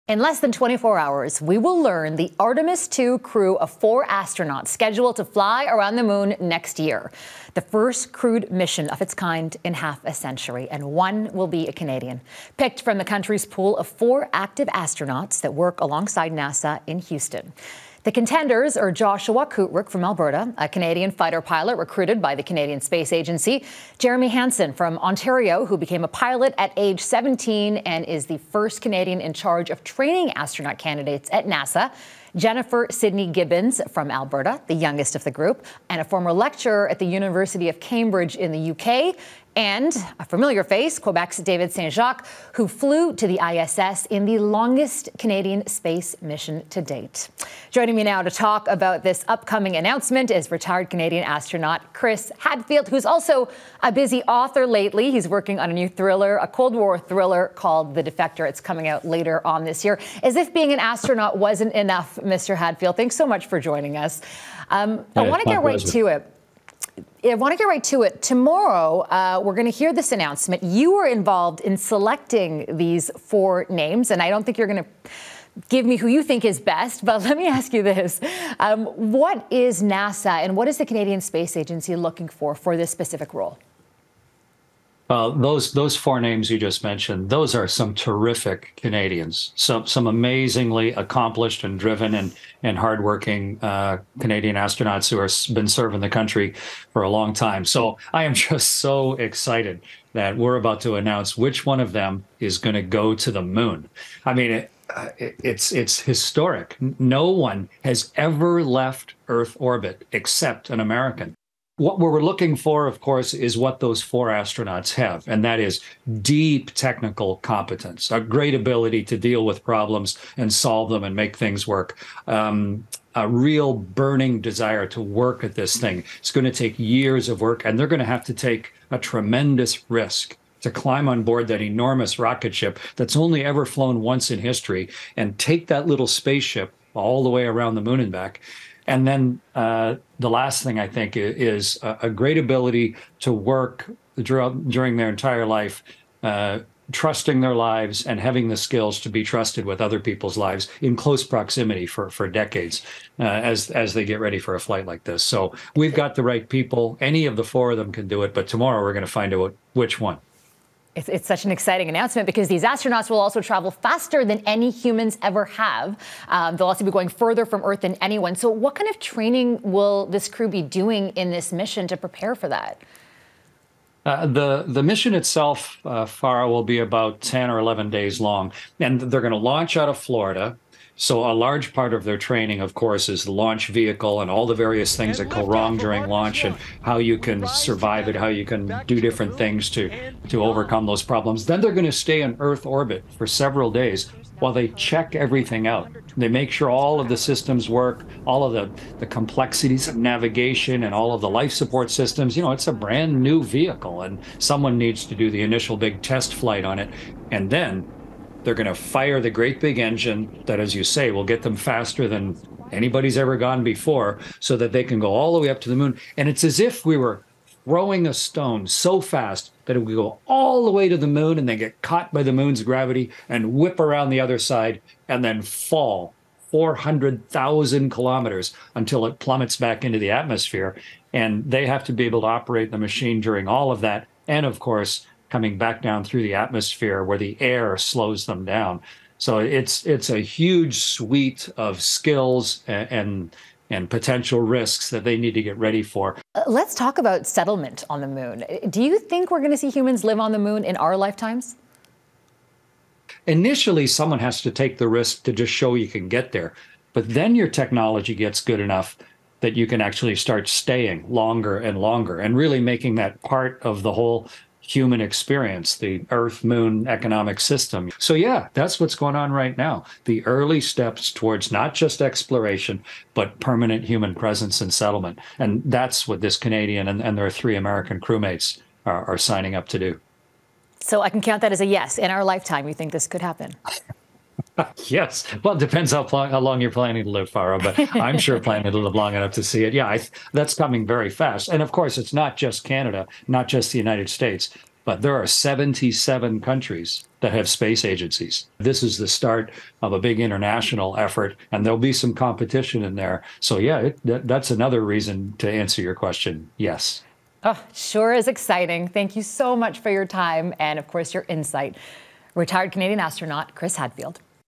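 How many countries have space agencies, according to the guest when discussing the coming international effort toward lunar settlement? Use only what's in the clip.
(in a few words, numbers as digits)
77.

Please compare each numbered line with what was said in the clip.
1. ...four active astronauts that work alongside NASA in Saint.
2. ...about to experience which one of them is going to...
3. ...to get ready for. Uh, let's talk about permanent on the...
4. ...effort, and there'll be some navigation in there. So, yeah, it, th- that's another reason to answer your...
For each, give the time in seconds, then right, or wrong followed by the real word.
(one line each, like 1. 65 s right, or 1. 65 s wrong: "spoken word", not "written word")
1. 13 s wrong: "Houston", not "Saint"
2. 100 s wrong: "announce", not "experience"
3. 245 s wrong: "settlement", not "permanent"
4. 300 s wrong: "competition", not "navigation".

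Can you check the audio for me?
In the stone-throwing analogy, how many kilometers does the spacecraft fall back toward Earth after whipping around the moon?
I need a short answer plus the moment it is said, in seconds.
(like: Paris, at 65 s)
400,000 kilometers, at 226 s.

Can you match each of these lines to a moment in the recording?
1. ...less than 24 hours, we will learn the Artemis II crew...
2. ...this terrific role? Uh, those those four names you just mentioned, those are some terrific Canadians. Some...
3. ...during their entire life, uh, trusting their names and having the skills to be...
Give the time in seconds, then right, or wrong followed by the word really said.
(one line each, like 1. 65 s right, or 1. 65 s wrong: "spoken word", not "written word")
1. 0 s right
2. 82 s wrong: "specific", not "terrific"
3. 144 s wrong: "lives", not "names".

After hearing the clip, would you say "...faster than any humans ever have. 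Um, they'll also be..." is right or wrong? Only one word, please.
right.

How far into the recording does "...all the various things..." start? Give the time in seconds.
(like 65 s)
184 s.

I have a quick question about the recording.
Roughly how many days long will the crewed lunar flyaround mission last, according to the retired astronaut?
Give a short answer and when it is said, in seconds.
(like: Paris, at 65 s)
10 or 11 days, at 177 s.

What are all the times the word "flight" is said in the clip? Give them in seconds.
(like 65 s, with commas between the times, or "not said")
154 s, 206 s.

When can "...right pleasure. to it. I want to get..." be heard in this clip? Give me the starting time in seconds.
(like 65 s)
65 s.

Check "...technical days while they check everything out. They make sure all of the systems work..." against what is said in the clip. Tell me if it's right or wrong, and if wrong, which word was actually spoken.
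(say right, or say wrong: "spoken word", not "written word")
wrong: "several", not "technical".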